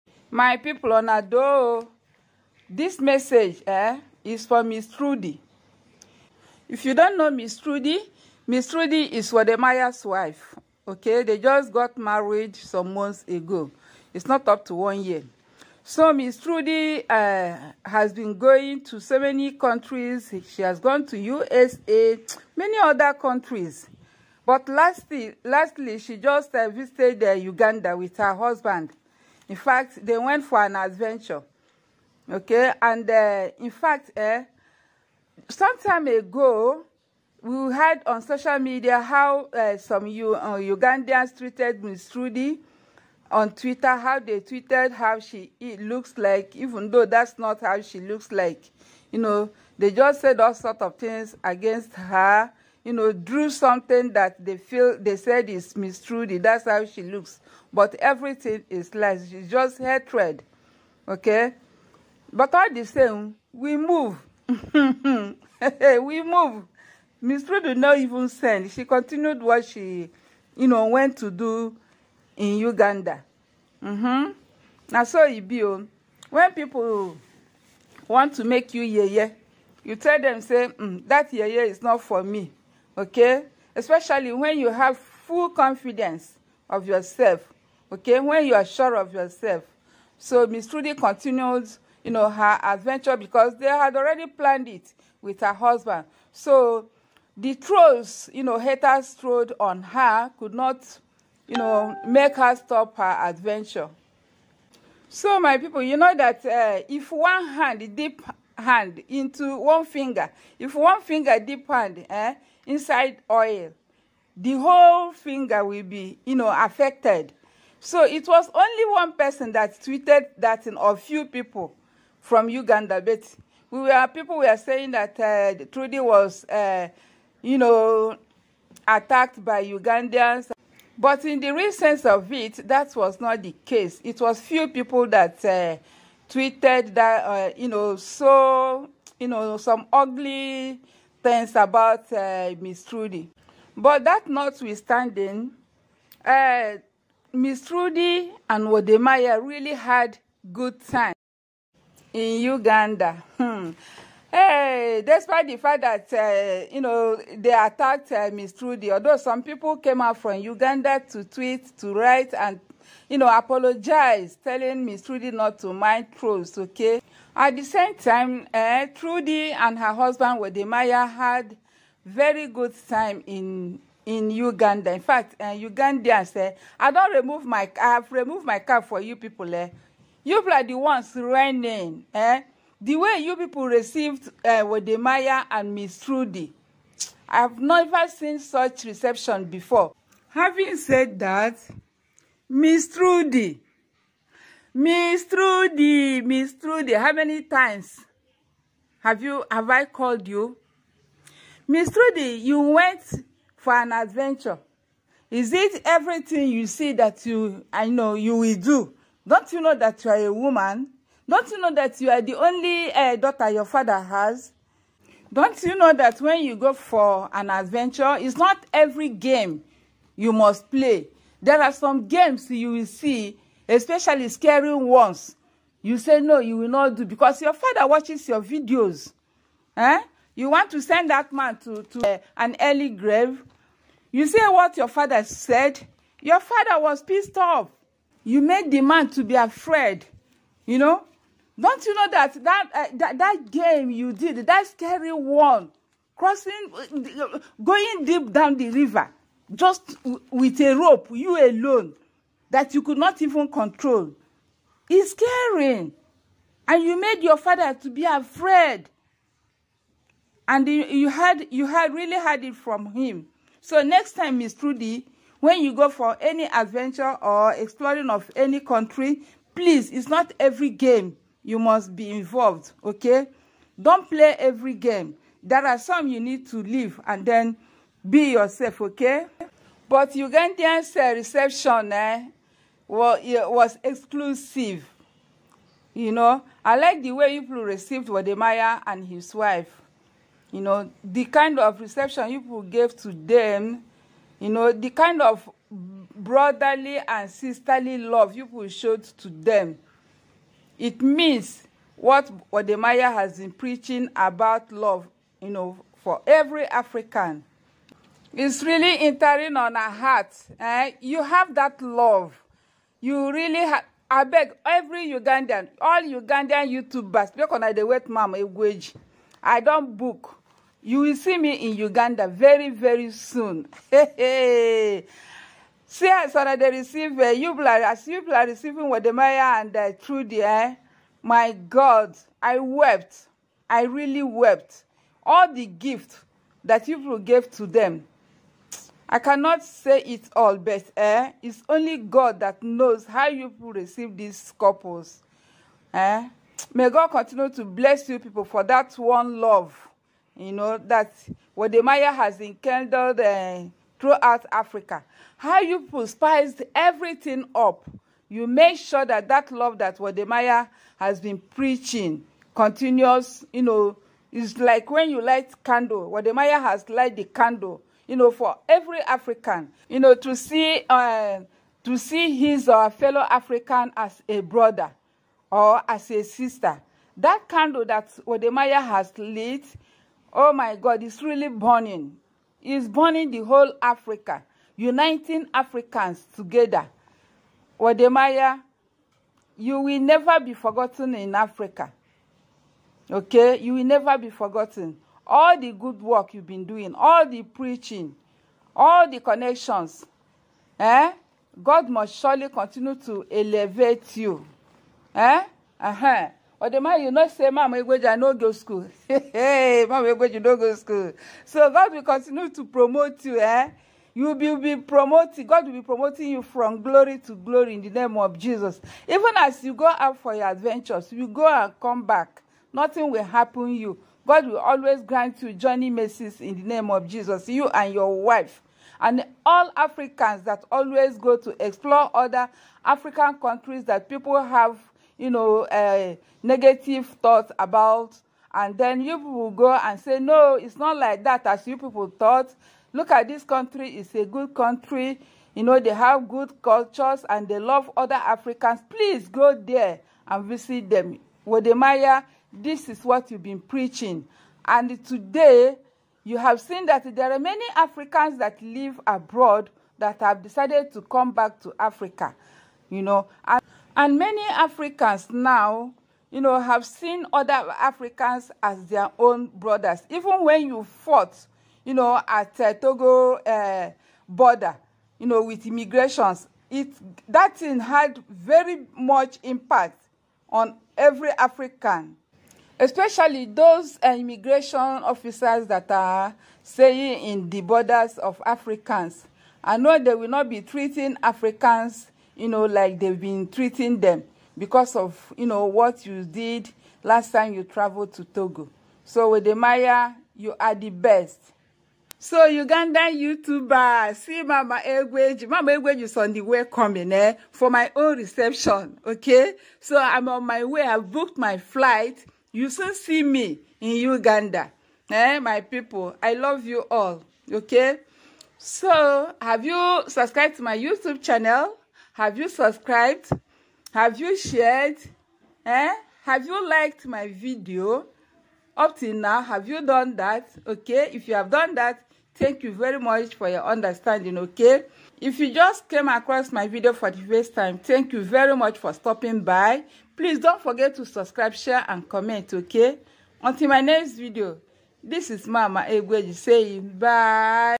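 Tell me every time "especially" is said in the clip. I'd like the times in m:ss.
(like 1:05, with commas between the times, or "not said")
1:23, 3:43, 8:02.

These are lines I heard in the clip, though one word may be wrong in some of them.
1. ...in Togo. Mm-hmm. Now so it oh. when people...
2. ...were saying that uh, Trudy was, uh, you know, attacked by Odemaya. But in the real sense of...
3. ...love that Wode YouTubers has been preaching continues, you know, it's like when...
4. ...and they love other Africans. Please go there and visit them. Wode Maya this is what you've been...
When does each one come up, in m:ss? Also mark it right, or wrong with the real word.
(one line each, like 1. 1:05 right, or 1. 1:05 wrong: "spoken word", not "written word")
1. 1:12 wrong: "Uganda", not "Togo"
2. 2:04 wrong: "Ugandans", not "Odemaya"
3. 5:59 wrong: "Maya", not "YouTubers"
4. 7:27 right.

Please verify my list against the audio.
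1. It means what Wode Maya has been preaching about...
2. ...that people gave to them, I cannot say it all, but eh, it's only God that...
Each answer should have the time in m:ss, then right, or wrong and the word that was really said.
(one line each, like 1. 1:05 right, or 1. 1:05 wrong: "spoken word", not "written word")
1. 5:00 right
2. 5:36 right.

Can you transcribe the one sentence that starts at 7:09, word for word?
And all Africans that always go to explore other African countries that people have, you know, uh, negative thoughts about.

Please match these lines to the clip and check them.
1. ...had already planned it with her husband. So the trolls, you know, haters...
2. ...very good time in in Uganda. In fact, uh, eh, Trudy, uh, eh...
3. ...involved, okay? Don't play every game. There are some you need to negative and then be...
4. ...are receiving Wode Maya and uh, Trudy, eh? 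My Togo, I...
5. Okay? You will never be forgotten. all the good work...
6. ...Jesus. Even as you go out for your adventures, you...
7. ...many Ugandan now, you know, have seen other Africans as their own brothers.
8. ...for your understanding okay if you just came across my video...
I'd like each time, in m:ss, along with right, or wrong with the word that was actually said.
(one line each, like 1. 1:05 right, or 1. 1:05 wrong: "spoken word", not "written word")
1. 1:33 right
2. 2:52 wrong: "Ugandans", not "Trudy"
3. 4:32 wrong: "leave", not "negative"
4. 5:28 wrong: "God", not "Togo"
5. 6:33 right
6. 6:58 right
7. 7:44 wrong: "Africans", not "Ugandan"
8. 8:53 right.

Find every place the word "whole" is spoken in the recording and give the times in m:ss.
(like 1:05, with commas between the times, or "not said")
1:54, 6:23.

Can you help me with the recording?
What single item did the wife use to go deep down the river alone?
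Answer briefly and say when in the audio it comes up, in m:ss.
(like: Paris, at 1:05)
a rope, at 4:10.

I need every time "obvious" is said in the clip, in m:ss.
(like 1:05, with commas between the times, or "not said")
not said.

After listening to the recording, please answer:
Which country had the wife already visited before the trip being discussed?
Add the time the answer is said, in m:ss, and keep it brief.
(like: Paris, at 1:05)
USA, at 0:21.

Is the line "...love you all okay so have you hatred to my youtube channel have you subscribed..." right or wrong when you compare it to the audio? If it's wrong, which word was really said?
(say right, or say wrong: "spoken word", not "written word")
wrong: "subscribed", not "hatred".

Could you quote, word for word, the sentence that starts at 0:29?
In fact, they went for an adventure.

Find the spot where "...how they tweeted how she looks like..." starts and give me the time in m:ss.
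0:43.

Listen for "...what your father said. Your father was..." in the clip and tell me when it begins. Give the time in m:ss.
3:54.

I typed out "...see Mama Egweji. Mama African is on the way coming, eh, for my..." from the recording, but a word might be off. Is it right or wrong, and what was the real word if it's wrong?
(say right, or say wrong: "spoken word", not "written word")
wrong: "Egweji", not "African".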